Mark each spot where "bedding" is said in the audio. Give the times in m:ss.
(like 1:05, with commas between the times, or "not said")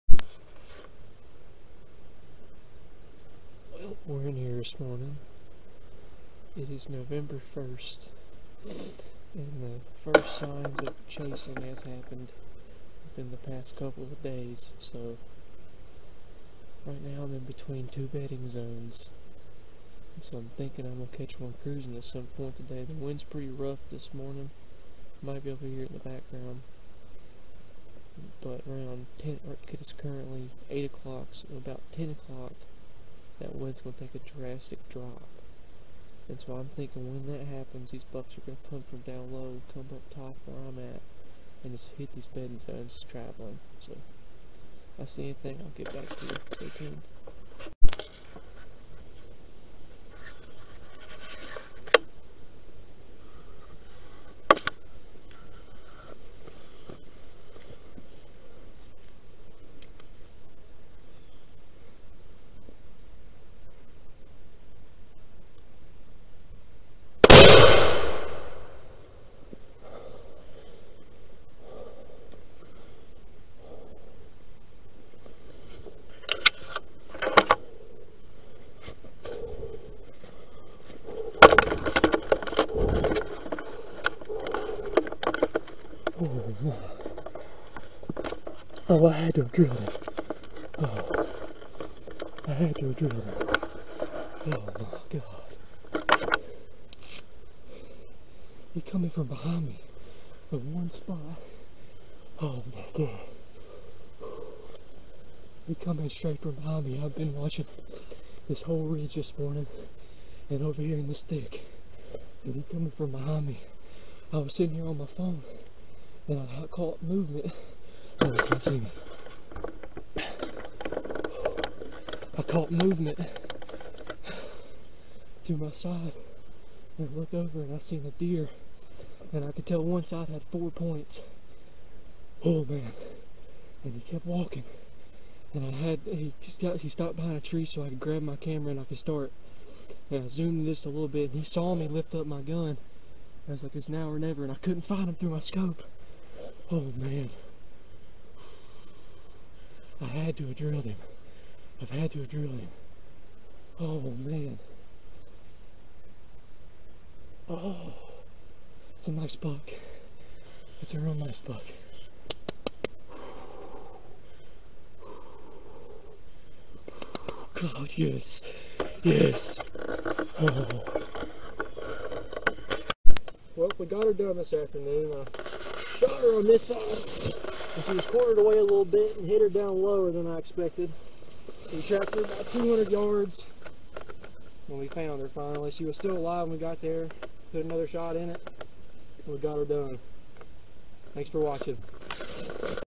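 0:18, 0:42.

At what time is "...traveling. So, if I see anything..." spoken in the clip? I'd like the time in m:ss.
0:43.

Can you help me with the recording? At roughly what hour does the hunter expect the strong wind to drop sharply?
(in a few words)
10 o'clock.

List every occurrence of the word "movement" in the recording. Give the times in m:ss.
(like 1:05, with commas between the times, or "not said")
1:57, 2:02.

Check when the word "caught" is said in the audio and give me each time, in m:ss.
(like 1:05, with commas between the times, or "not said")
1:56, 2:02.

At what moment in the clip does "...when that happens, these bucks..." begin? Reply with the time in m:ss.
0:37.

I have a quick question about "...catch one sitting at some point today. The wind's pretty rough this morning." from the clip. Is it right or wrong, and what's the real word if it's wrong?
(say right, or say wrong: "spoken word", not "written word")
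wrong: "cruising", not "sitting".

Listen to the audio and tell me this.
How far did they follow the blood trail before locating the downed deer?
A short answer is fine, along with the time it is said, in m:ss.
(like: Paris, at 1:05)
200 yards, at 3:02.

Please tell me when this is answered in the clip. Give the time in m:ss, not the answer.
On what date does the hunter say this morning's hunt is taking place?
0:06.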